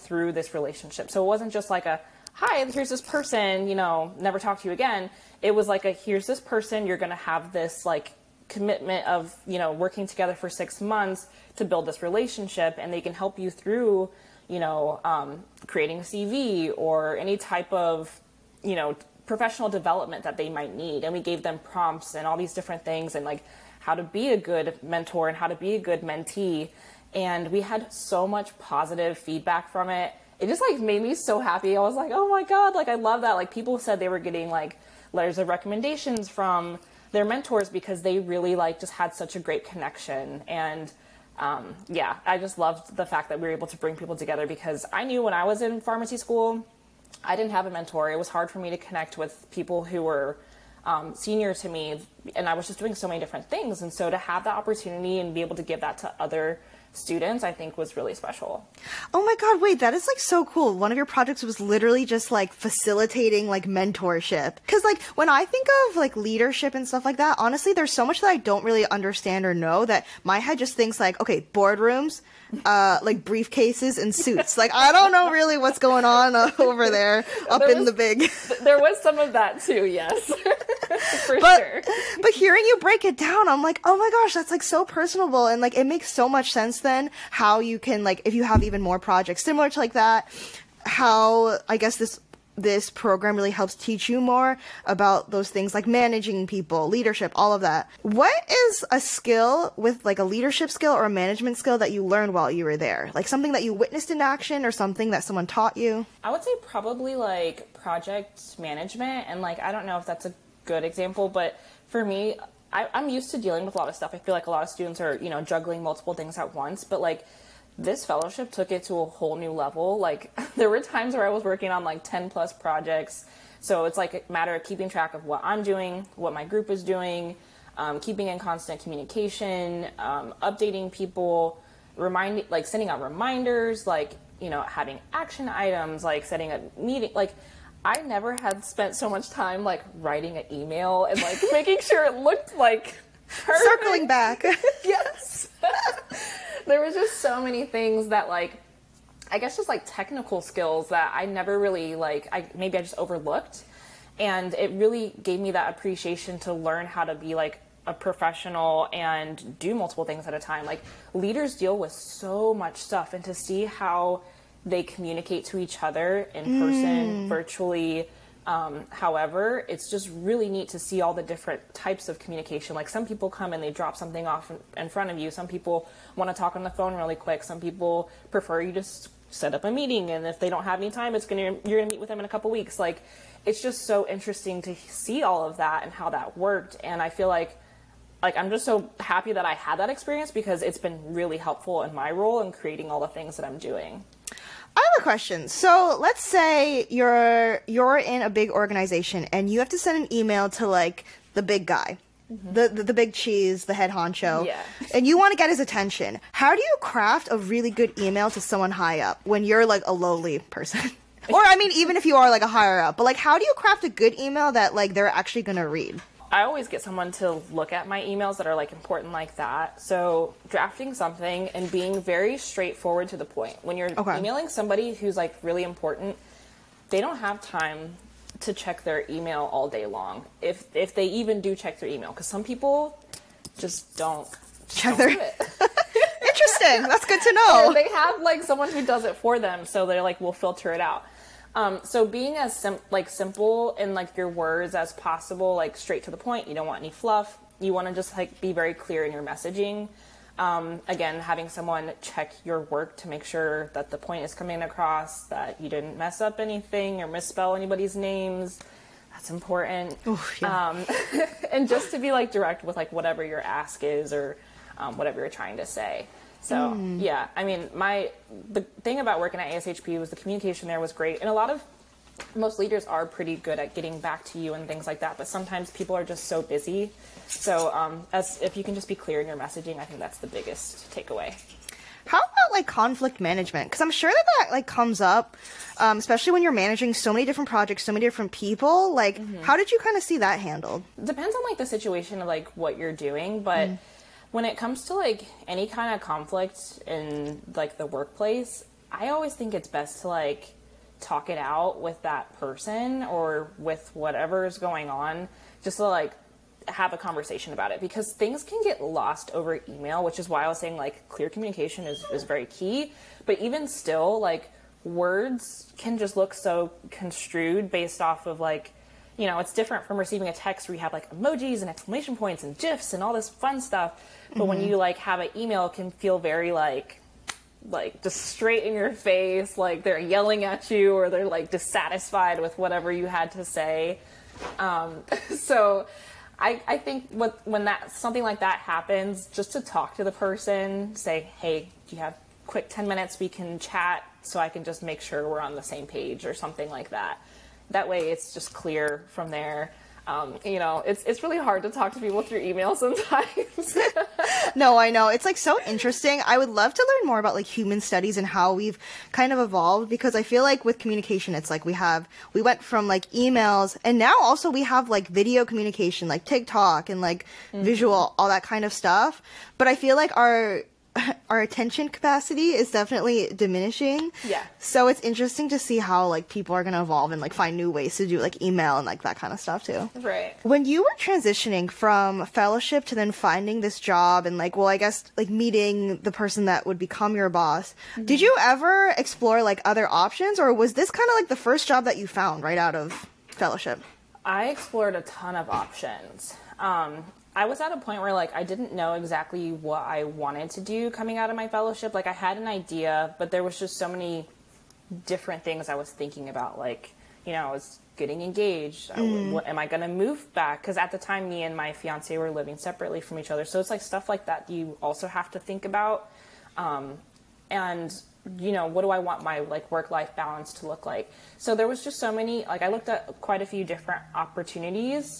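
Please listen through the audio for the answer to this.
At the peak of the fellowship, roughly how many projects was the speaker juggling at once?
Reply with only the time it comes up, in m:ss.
2:02.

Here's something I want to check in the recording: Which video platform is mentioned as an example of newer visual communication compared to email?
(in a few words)
TikTok.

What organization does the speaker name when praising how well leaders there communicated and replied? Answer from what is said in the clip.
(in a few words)
ASHP.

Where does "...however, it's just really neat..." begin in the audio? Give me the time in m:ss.
2:48.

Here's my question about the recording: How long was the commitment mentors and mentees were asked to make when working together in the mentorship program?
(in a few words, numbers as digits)
6 months.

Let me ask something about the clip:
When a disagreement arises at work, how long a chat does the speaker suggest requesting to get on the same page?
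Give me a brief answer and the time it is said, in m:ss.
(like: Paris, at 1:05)
10 minutes, at 5:42.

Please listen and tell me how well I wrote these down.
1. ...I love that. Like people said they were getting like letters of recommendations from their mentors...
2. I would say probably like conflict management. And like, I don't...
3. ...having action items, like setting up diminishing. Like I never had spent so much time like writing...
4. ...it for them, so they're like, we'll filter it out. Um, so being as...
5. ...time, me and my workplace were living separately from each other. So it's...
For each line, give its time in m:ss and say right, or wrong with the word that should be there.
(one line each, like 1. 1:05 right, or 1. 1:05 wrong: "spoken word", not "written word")
1. 0:32 right
2. 1:46 wrong: "project", not "conflict"
3. 2:14 wrong: "meeting", not "diminishing"
4. 3:59 right
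5. 6:50 wrong: "fiance", not "workplace".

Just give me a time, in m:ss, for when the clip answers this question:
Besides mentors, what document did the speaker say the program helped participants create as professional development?
0:16.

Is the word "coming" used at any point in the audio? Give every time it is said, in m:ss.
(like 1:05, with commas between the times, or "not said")
4:14, 6:40.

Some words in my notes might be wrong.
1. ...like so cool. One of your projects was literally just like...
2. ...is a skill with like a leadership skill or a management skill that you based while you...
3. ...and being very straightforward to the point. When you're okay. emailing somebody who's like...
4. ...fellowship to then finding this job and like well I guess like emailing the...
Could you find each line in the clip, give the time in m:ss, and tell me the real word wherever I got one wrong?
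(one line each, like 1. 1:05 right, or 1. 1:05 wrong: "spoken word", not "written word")
1. 1:00 right
2. 1:38 wrong: "learned", not "based"
3. 3:41 right
4. 6:22 wrong: "meeting", not "emailing".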